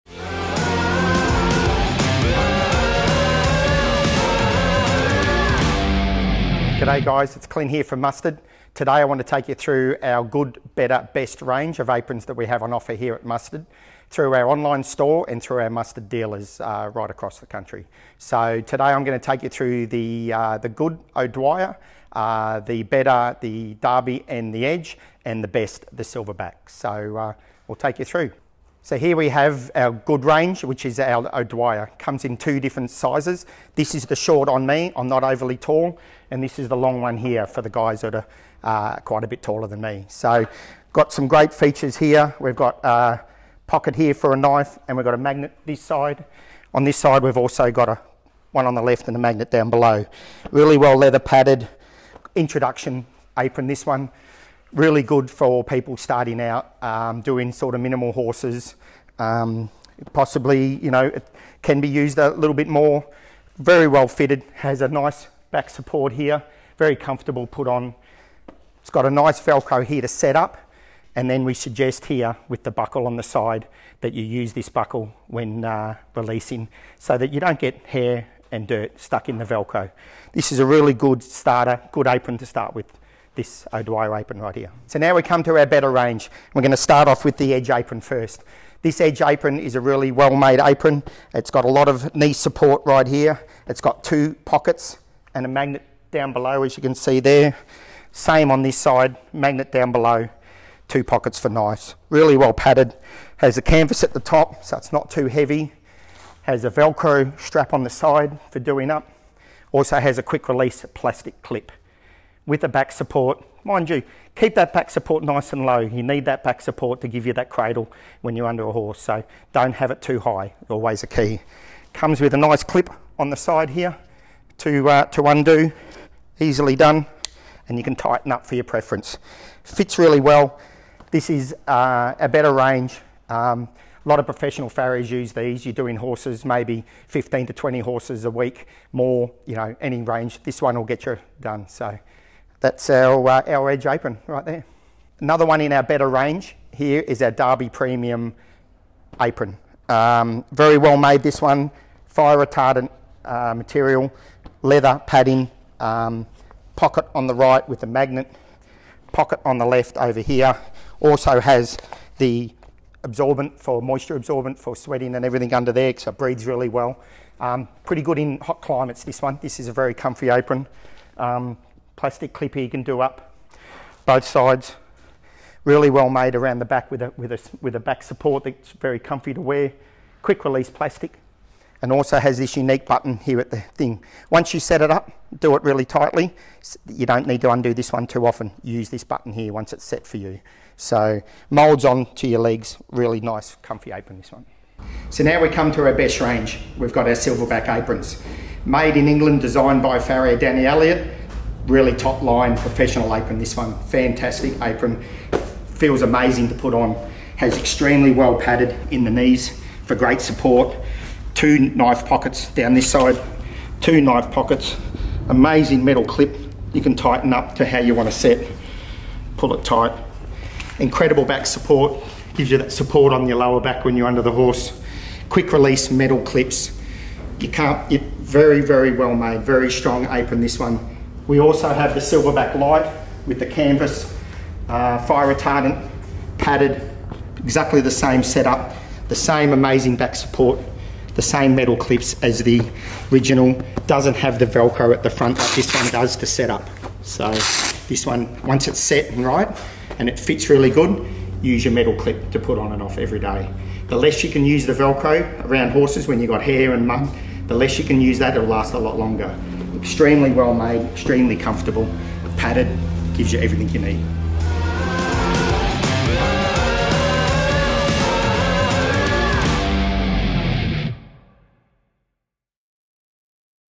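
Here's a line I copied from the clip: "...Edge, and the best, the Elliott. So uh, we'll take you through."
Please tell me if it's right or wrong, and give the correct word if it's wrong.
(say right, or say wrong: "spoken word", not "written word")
wrong: "Silverback", not "Elliott".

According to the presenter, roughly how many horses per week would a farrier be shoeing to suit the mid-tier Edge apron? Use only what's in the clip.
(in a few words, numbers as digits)
15 to 20.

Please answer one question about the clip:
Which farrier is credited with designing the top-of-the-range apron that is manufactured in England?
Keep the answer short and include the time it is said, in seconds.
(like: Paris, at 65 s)
Danny Elliott, at 200 s.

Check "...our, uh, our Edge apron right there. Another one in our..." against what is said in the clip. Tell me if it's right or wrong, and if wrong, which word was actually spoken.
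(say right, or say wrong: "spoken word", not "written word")
right.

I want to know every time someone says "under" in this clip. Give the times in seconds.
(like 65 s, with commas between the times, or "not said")
118 s, 165 s, 224 s.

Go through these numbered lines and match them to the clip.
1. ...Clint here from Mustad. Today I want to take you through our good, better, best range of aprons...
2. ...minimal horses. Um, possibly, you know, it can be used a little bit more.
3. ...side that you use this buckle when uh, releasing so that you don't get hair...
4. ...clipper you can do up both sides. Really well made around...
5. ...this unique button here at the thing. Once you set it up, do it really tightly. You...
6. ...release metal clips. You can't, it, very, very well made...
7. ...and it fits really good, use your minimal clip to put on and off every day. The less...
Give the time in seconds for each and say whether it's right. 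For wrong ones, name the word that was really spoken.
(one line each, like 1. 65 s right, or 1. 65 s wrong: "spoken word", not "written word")
1. 7 s right
2. 57 s right
3. 73 s right
4. 172 s right
5. 182 s right
6. 225 s right
7. 249 s wrong: "metal", not "minimal".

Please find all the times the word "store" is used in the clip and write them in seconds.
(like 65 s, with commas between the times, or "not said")
14 s.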